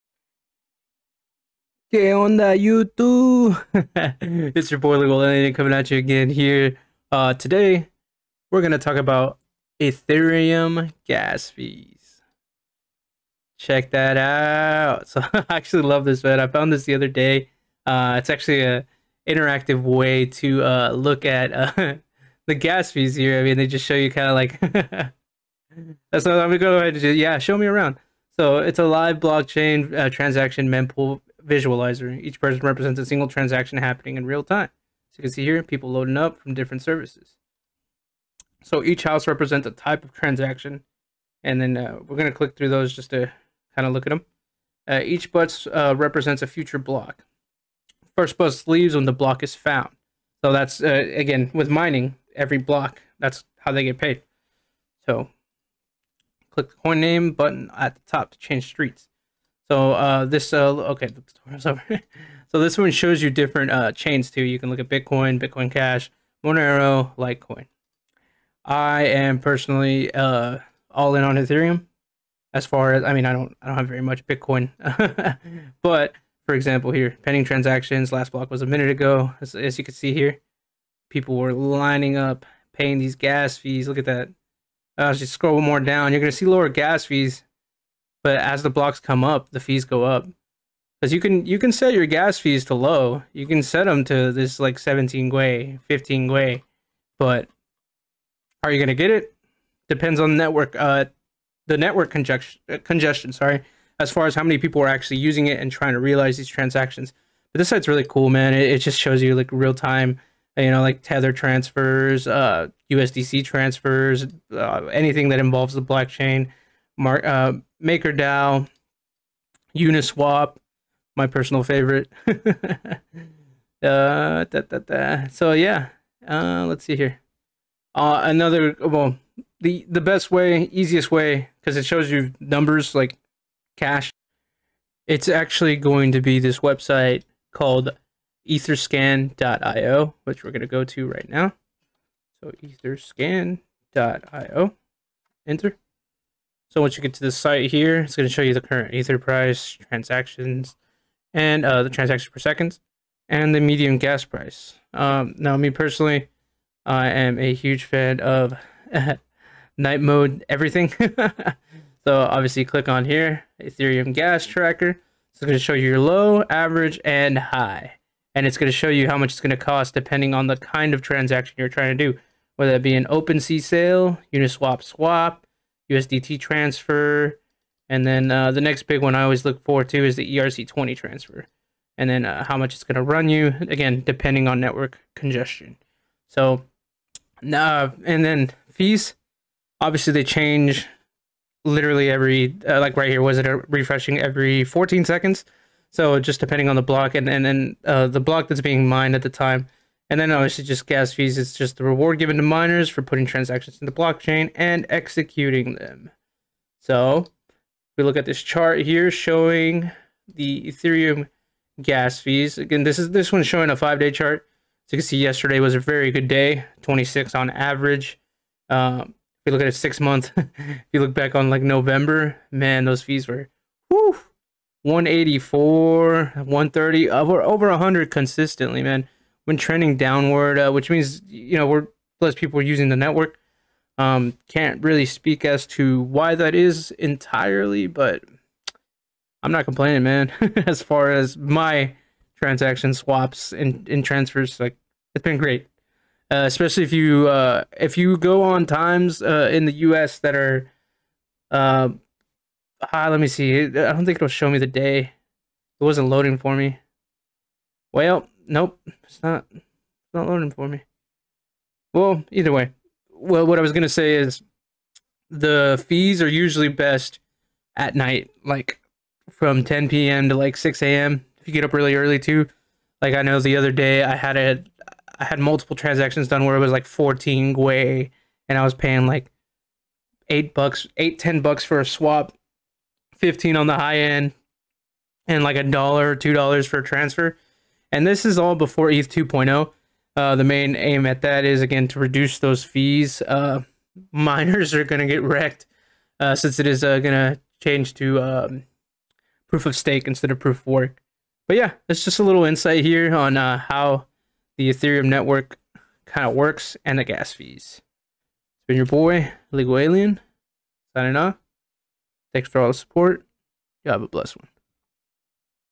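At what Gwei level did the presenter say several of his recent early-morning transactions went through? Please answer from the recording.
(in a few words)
14 Gwei.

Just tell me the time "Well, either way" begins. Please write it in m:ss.
4:21.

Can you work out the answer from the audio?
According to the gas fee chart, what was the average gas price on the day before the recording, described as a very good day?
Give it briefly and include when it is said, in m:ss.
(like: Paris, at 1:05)
26, at 3:36.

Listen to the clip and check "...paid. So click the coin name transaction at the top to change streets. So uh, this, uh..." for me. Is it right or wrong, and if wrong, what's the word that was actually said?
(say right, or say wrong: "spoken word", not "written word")
wrong: "button", not "transaction".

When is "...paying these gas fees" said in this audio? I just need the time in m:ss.
1:22.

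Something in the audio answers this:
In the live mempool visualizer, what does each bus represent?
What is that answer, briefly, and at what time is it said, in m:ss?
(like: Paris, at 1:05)
A future block, at 0:46.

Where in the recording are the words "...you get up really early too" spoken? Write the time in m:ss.
4:31.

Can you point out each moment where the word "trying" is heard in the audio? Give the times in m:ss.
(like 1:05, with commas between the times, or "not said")
1:45, 2:51.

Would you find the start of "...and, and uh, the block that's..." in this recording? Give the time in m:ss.
3:17.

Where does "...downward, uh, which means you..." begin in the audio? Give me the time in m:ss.
3:49.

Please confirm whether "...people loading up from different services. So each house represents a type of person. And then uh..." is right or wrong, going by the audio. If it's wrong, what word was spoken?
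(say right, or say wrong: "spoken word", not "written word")
wrong: "transaction", not "person".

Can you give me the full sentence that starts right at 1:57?
uh, MakerDAO, Uniswap, my personal favorite.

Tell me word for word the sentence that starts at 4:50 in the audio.
Uh, the main aim at that is, again, to reduce those fees.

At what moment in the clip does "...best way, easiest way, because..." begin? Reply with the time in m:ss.
2:10.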